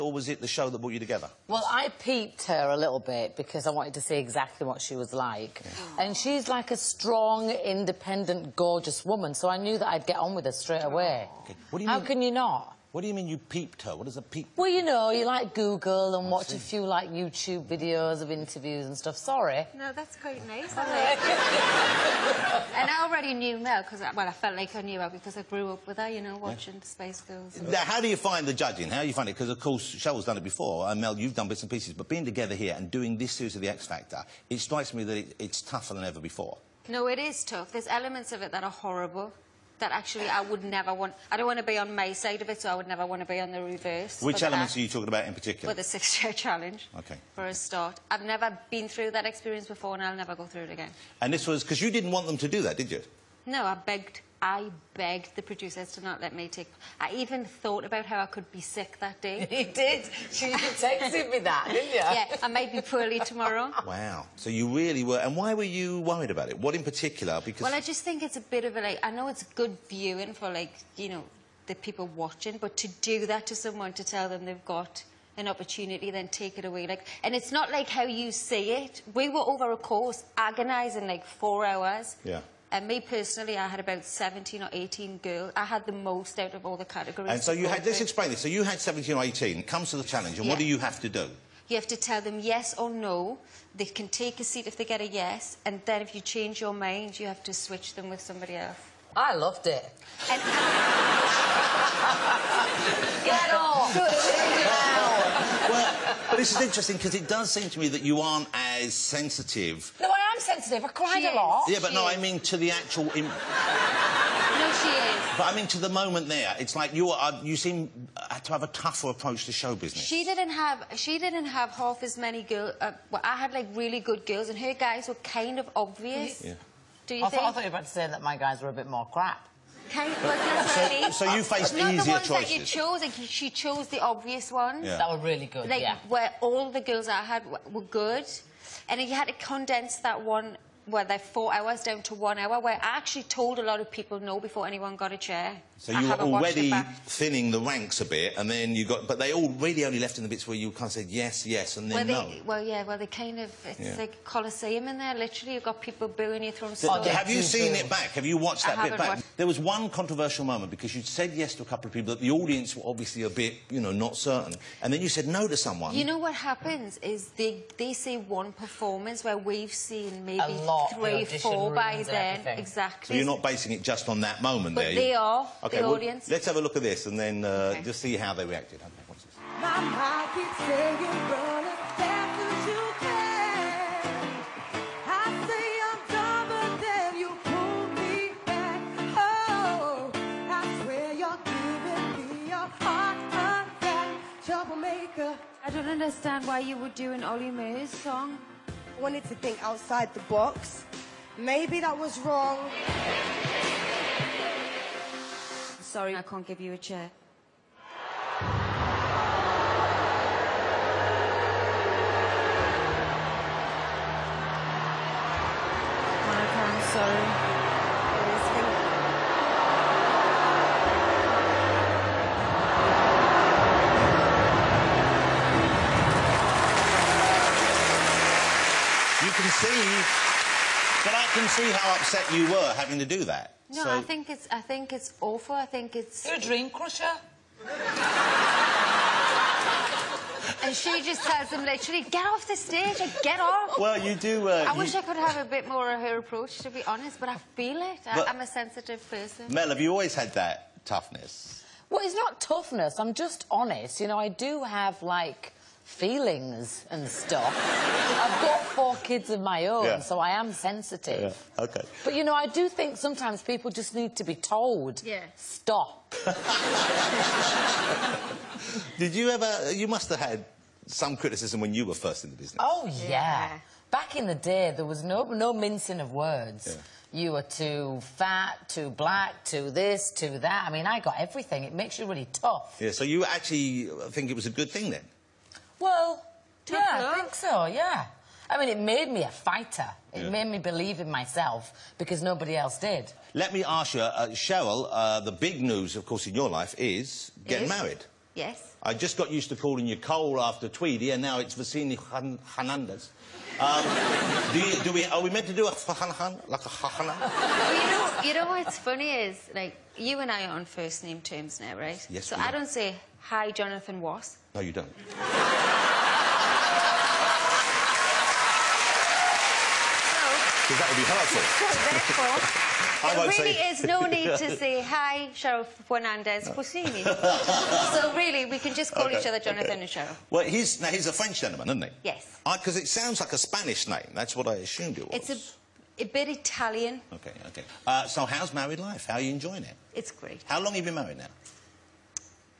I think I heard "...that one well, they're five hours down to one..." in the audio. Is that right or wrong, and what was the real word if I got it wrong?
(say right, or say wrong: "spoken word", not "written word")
wrong: "four", not "five".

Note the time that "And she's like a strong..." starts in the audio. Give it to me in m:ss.
0:06.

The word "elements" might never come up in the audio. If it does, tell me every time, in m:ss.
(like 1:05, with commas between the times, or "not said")
0:37, 0:44.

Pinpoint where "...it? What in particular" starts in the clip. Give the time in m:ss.
1:06.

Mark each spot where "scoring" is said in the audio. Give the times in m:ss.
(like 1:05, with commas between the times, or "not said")
not said.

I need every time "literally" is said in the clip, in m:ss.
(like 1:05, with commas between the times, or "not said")
2:35, 4:01.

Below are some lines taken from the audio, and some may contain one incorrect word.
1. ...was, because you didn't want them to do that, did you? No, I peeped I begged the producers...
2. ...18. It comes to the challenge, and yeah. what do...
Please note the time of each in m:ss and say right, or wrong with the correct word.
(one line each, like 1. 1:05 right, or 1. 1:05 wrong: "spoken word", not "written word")
1. 0:51 wrong: "begged", not "peeped"
2. 1:29 right.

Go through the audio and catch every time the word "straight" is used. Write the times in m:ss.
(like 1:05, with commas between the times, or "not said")
0:10.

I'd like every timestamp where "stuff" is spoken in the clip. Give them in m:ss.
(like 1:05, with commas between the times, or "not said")
0:18, 4:17.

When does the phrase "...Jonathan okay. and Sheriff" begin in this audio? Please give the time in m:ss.
5:29.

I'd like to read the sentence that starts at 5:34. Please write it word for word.
That's what I assumed it was.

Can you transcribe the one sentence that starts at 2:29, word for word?
But they all really only left in the bits where you kind of said yes, yes, and then well, they, no.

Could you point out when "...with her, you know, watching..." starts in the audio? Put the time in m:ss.
0:25.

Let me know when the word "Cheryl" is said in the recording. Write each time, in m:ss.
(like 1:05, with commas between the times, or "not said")
0:29, 4:54.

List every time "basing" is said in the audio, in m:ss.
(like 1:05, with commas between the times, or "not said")
2:53.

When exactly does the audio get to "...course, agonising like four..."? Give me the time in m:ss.
1:19.